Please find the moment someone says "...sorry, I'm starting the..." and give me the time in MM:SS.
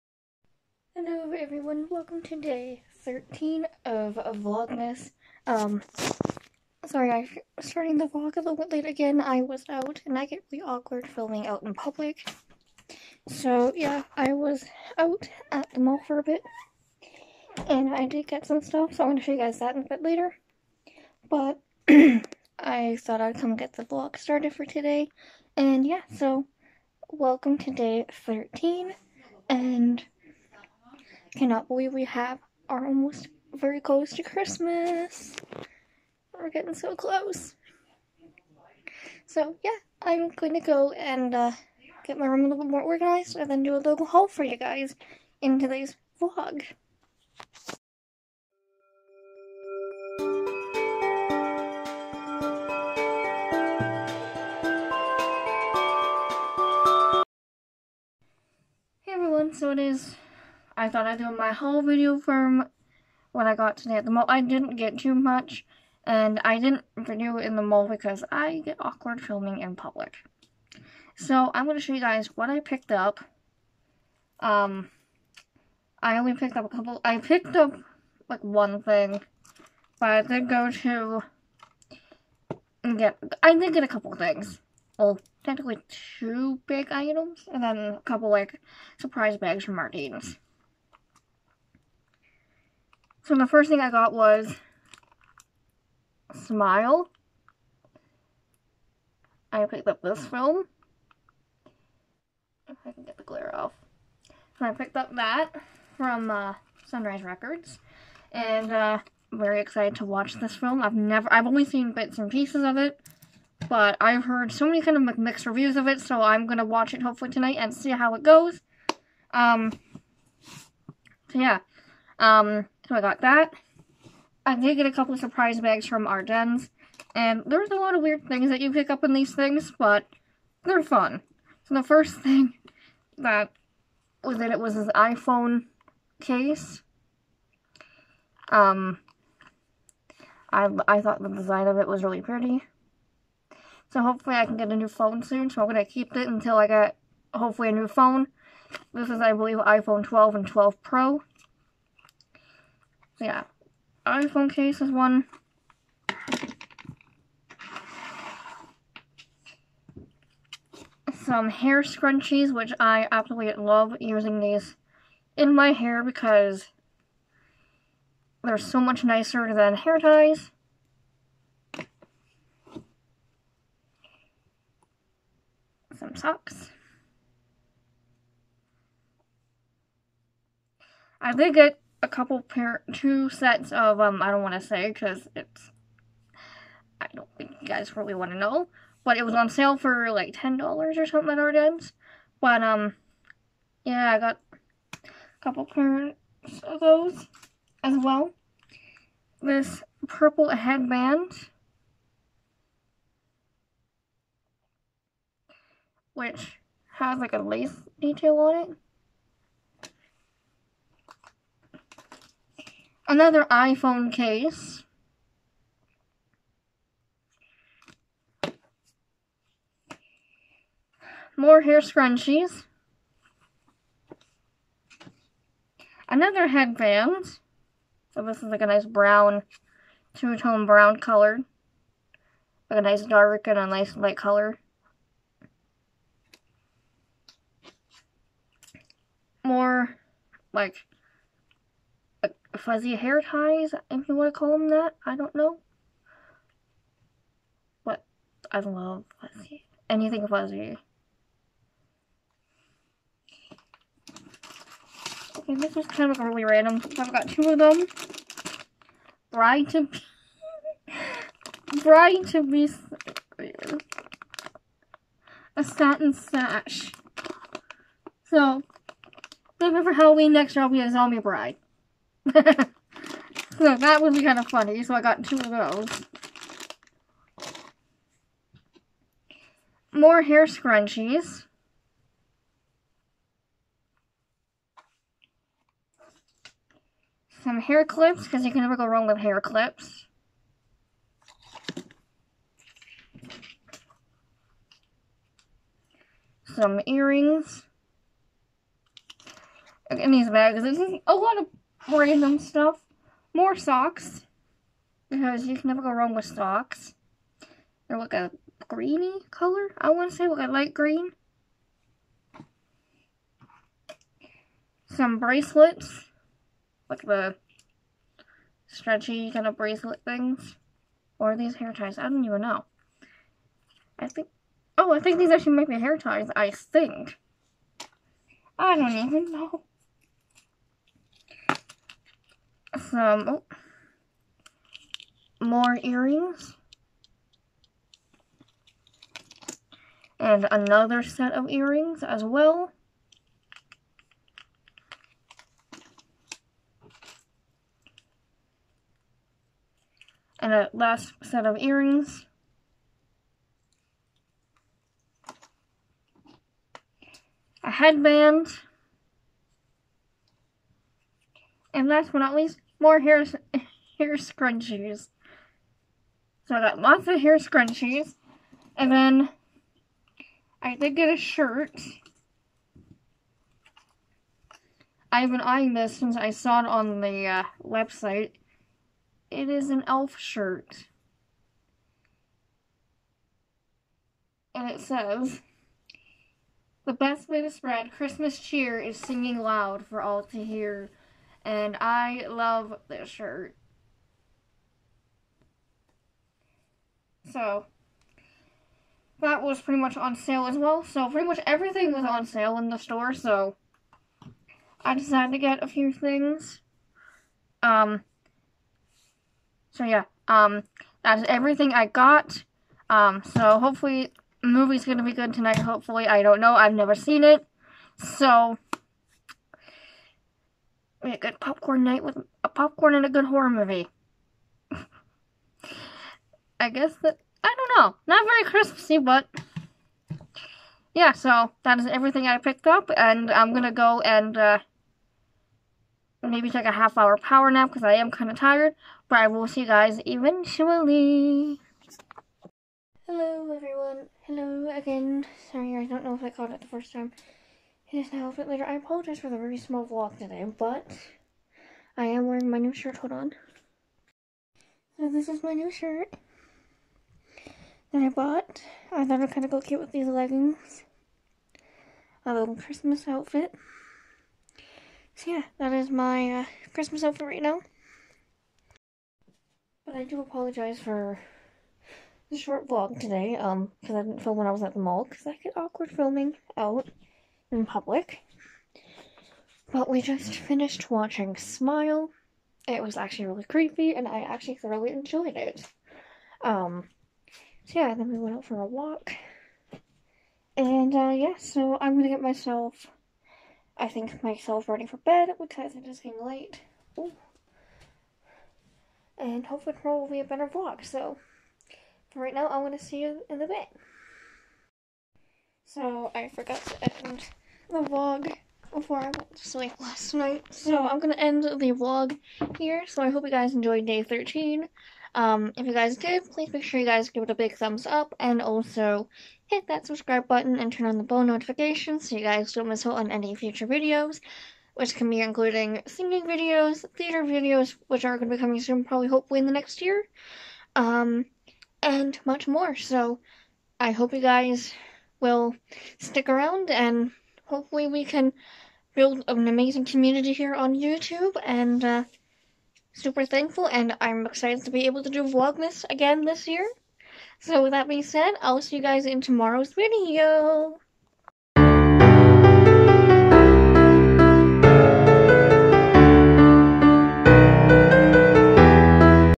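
00:06.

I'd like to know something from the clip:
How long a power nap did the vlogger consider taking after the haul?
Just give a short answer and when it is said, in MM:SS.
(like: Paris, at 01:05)
Half hour, at 07:16.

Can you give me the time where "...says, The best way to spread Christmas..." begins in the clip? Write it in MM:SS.
06:24.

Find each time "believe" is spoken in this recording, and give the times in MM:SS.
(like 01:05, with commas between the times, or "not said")
00:31, 02:29.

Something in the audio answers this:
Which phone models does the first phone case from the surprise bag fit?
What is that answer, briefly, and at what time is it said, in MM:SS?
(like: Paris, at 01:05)
iPhone 12 and 12 Pro, at 02:29.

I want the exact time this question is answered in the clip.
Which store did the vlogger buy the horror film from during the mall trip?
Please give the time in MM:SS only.
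01:46.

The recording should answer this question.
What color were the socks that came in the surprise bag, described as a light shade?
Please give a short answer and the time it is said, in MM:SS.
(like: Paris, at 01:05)
Light green, at 05:10.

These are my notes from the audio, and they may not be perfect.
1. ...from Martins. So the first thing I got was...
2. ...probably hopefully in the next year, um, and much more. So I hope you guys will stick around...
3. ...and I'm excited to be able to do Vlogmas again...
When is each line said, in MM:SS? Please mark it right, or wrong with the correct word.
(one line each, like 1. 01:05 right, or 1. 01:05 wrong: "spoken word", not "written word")
1. 01:29 right
2. 08:48 right
3. 09:03 right.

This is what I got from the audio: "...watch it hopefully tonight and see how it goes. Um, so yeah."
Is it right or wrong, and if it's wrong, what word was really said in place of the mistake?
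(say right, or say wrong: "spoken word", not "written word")
right.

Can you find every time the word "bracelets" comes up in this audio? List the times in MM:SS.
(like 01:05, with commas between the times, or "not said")
05:15, 05:19.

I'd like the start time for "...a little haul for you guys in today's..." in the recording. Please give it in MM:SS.
00:43.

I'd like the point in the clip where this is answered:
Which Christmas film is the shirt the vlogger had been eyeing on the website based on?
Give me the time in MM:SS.
06:19.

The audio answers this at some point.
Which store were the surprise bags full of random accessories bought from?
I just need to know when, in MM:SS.
02:06.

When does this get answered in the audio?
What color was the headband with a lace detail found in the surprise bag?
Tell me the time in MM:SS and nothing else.
03:20.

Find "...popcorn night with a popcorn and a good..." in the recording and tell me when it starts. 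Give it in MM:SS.
07:01.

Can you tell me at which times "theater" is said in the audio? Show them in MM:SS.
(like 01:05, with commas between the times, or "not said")
08:46.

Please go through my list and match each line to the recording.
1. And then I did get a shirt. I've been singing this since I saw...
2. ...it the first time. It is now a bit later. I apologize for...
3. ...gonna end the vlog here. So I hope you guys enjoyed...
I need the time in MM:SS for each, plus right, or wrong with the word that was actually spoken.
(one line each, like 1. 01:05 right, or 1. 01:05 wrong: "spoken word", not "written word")
1. 06:08 wrong: "eyeing", not "singing"
2. 07:26 right
3. 08:30 right.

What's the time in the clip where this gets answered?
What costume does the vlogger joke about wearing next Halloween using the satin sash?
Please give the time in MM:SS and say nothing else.
04:30.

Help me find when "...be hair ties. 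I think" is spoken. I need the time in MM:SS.
05:25.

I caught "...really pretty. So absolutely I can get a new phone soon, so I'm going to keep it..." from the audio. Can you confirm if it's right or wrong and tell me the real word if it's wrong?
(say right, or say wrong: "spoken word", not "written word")
wrong: "hopefully", not "absolutely".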